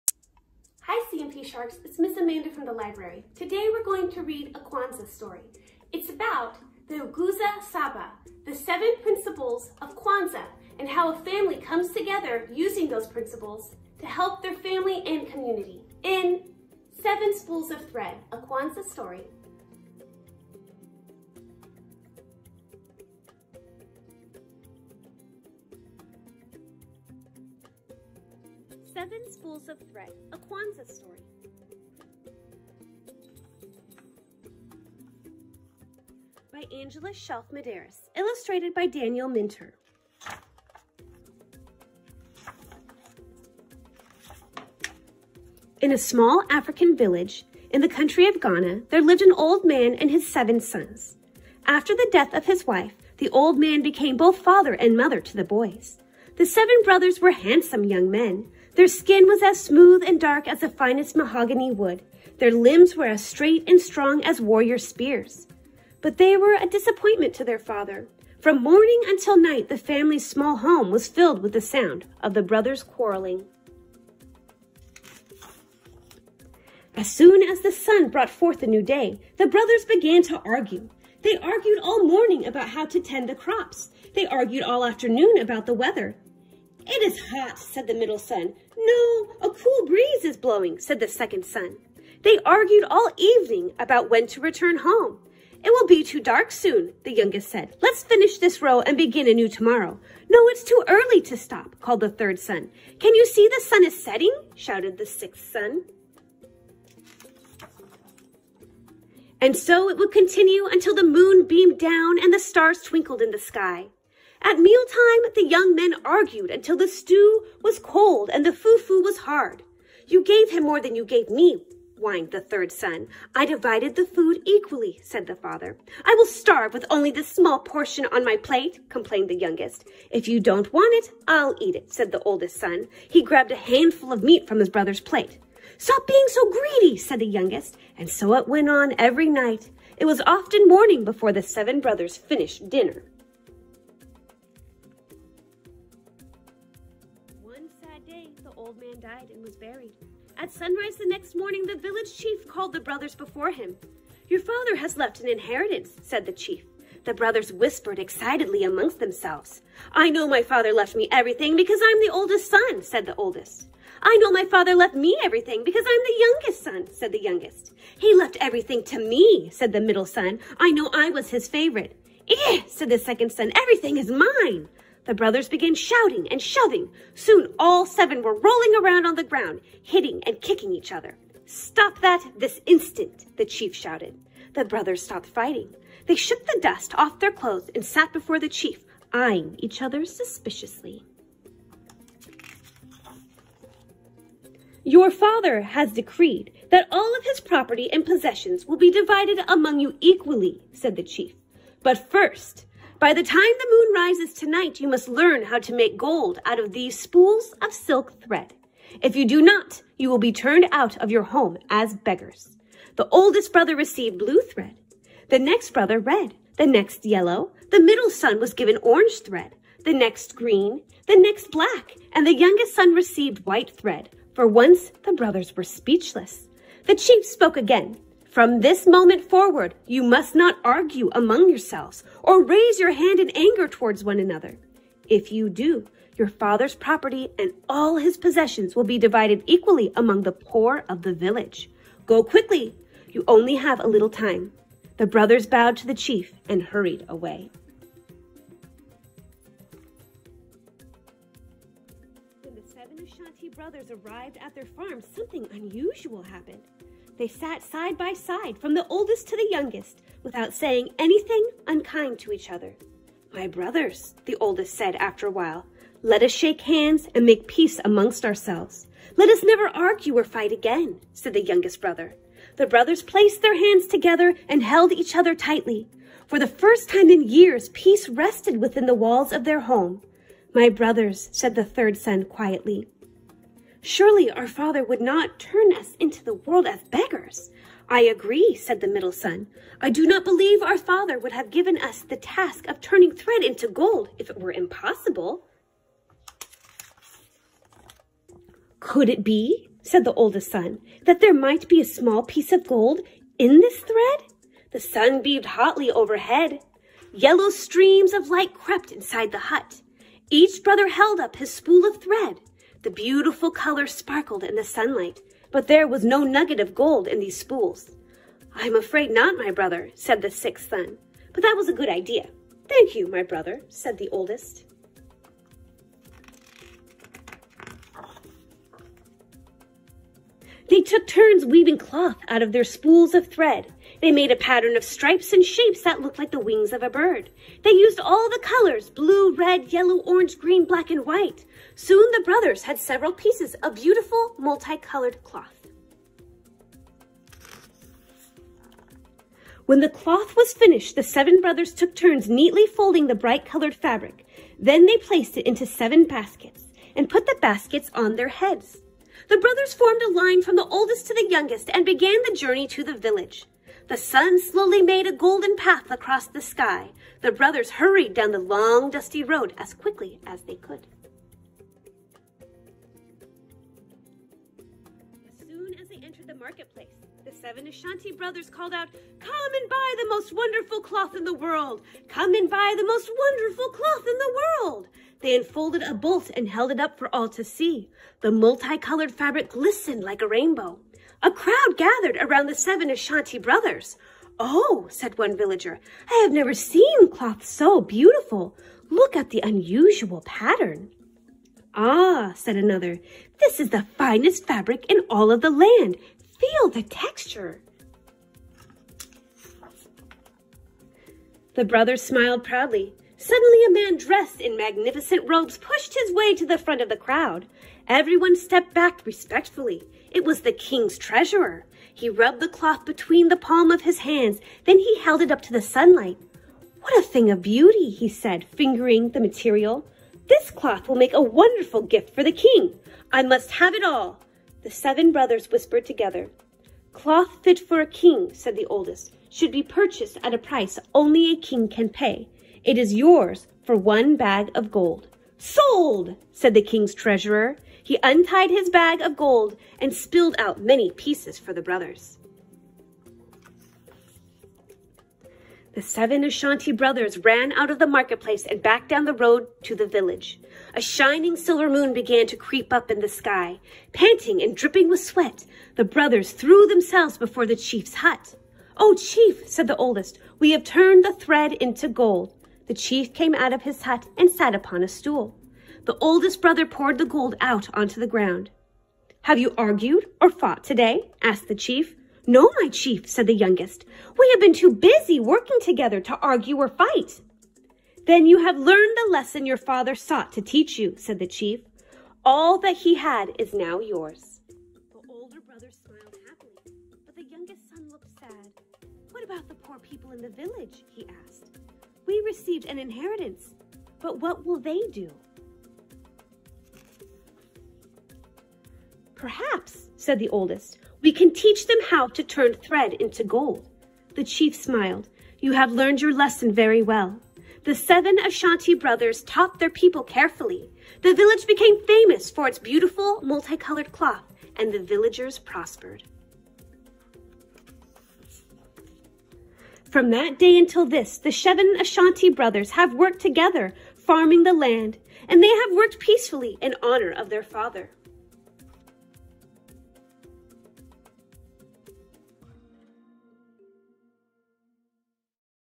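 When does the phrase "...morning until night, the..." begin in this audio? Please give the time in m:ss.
1:08.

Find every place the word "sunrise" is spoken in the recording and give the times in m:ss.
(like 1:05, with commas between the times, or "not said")
2:30.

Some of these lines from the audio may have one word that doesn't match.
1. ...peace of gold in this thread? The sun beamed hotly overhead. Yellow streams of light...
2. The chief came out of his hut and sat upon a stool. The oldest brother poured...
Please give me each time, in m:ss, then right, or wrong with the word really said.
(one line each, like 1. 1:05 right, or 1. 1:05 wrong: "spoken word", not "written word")
1. 5:02 wrong: "piece", not "peace"
2. 7:52 right.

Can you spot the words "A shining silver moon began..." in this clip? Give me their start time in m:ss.
7:40.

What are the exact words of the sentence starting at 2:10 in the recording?
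If you don't want it, I'll eat it, said the oldest son.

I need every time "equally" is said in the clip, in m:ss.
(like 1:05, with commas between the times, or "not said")
2:04, 3:19, 3:59.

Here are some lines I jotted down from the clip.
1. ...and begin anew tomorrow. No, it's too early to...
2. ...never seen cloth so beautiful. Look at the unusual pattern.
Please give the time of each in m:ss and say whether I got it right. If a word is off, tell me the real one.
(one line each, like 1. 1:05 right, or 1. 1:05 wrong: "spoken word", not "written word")
1. 1:38 right
2. 6:36 right.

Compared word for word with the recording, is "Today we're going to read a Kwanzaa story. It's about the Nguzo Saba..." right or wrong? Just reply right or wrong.
right.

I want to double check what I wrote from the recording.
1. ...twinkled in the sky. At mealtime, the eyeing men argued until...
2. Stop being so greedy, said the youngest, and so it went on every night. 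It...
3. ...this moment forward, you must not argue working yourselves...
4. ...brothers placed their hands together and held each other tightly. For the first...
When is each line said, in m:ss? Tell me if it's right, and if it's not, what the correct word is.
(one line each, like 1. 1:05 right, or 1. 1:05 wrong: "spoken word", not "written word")
1. 1:52 wrong: "young", not "eyeing"
2. 2:15 right
3. 3:48 wrong: "among", not "working"
4. 4:32 right.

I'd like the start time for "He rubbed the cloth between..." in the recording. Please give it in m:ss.
7:01.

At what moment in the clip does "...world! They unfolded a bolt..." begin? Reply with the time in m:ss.
6:24.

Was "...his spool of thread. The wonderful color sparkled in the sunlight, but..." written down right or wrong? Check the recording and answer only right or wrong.
wrong.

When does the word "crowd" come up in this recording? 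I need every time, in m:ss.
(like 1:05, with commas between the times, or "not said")
6:31, 6:56.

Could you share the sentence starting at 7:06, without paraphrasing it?
What a thing of beauty, he said, fingering the material.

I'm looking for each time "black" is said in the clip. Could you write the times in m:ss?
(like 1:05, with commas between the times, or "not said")
3:41, 5:40.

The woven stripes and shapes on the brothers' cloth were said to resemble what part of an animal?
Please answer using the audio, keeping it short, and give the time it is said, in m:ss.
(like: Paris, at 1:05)
wings of a bird, at 5:36.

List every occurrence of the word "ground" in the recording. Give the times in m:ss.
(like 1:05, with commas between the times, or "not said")
2:59, 7:58.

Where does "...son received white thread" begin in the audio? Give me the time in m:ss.
3:42.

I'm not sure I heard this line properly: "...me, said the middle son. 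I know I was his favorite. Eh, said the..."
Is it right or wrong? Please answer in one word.
right.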